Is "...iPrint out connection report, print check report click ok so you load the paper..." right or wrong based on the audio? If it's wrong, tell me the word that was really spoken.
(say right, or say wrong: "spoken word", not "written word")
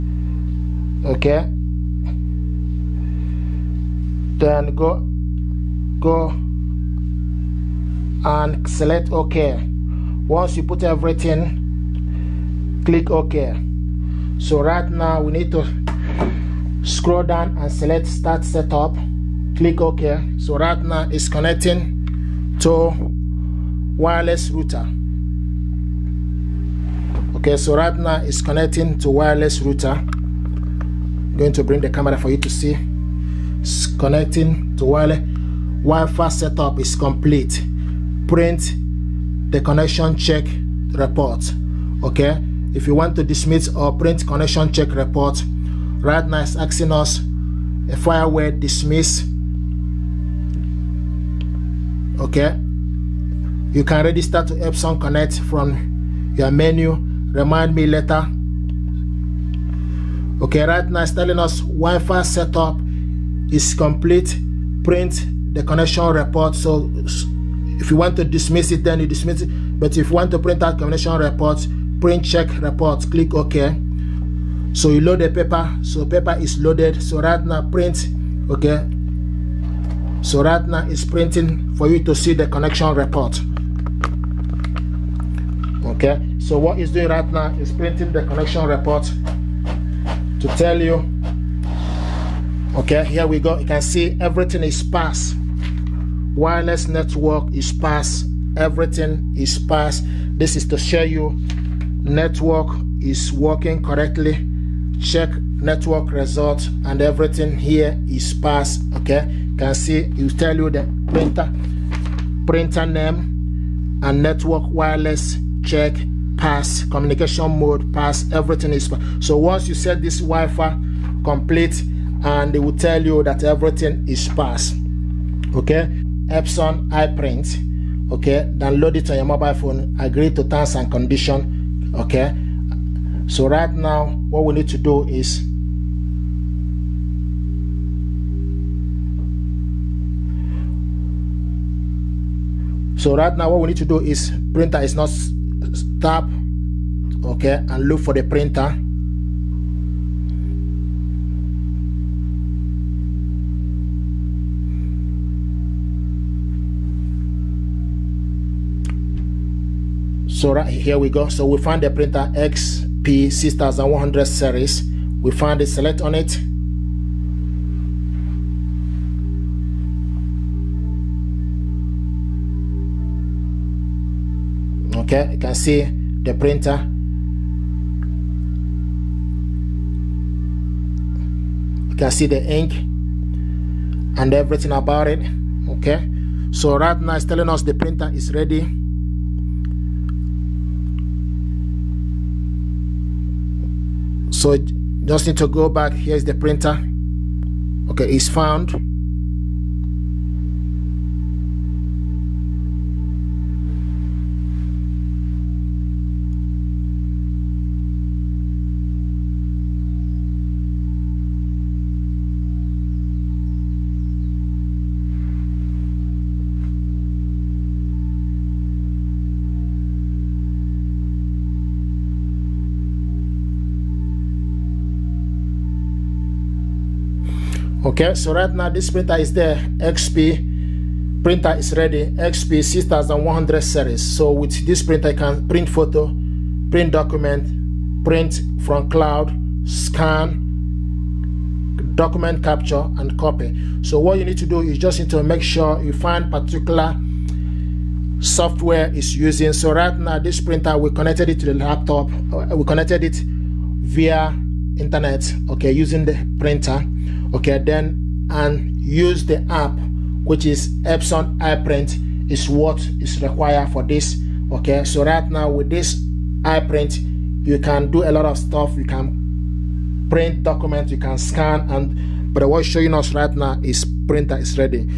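wrong: "print", not "iPrint".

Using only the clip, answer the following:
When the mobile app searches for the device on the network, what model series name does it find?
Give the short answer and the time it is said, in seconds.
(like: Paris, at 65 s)
XP6100 series, at 162 s.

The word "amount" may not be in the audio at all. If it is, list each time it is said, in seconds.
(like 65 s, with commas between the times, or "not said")
not said.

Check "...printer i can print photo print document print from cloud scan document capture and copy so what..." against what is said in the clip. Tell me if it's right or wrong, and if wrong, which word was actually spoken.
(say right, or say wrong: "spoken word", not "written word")
right.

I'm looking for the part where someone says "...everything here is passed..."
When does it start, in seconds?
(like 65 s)
107 s.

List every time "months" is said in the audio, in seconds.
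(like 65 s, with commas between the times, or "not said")
not said.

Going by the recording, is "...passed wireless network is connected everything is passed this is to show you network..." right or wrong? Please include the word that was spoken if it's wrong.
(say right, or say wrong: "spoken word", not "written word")
wrong: "passed", not "connected".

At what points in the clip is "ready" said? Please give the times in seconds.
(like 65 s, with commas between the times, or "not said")
188 s, 231 s.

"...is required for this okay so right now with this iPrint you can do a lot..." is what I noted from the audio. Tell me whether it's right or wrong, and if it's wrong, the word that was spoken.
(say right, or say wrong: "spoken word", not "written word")
right.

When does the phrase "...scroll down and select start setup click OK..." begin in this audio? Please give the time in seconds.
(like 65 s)
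16 s.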